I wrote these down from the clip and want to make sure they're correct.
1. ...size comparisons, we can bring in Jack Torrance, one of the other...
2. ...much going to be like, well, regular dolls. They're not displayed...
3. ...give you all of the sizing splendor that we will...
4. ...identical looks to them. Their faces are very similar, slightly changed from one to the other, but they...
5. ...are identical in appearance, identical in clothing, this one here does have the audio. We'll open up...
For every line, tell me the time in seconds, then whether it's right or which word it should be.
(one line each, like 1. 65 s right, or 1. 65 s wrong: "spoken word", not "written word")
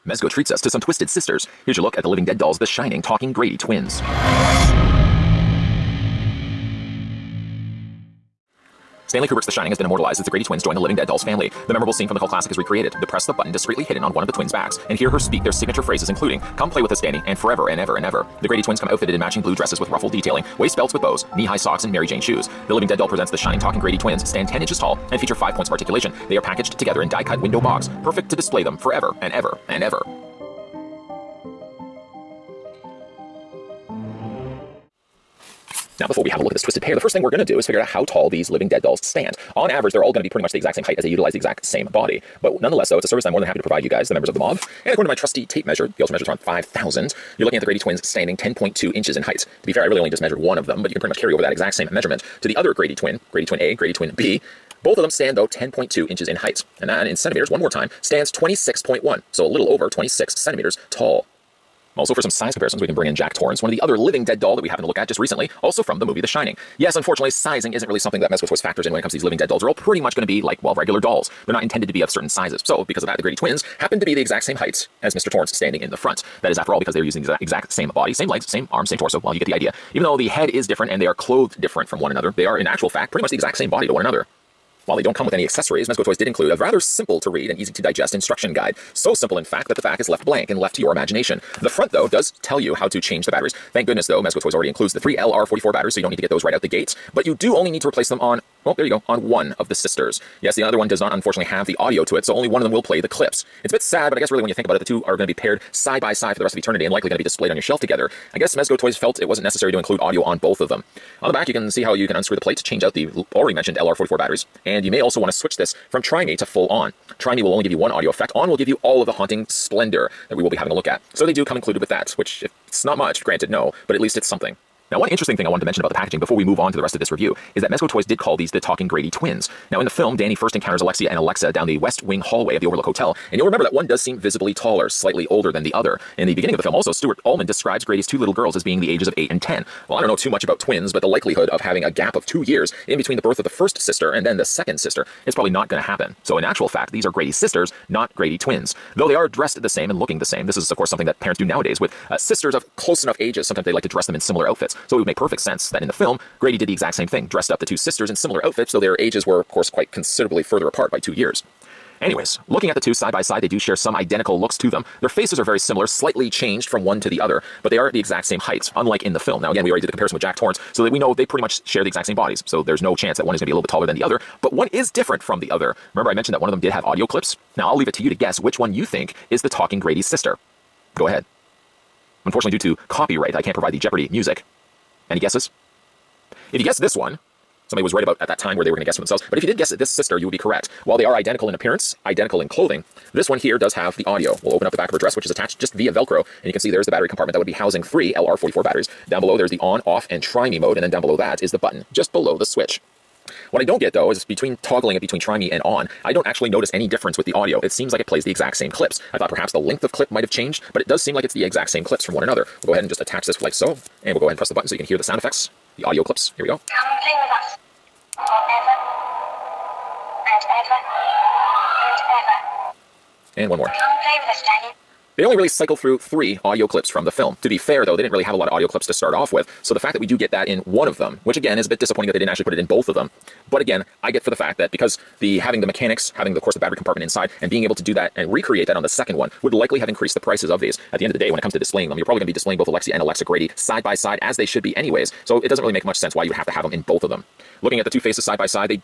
1. 62 s right
2. 69 s wrong: "intended", not "displayed"
3. 118 s wrong: "haunting", not "sizing"
4. 163 s right
5. 191 s right.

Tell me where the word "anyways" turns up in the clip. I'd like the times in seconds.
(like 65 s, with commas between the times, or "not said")
162 s, 244 s.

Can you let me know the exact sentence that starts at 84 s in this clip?
While they don't come with any accessories, Mezco Toys did include a rather simple to read and easy to digest instruction guide.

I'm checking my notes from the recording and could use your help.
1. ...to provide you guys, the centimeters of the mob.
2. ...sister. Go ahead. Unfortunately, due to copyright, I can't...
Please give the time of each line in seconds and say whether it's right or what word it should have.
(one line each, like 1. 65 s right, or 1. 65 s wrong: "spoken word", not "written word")
1. 43 s wrong: "members", not "centimeters"
2. 180 s right.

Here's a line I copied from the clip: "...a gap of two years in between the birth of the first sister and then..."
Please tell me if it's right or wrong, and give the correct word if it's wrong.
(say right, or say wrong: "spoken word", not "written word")
right.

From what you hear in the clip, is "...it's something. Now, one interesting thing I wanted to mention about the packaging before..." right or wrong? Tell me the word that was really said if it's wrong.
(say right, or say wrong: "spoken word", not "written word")
right.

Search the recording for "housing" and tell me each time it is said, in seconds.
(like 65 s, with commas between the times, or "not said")
197 s.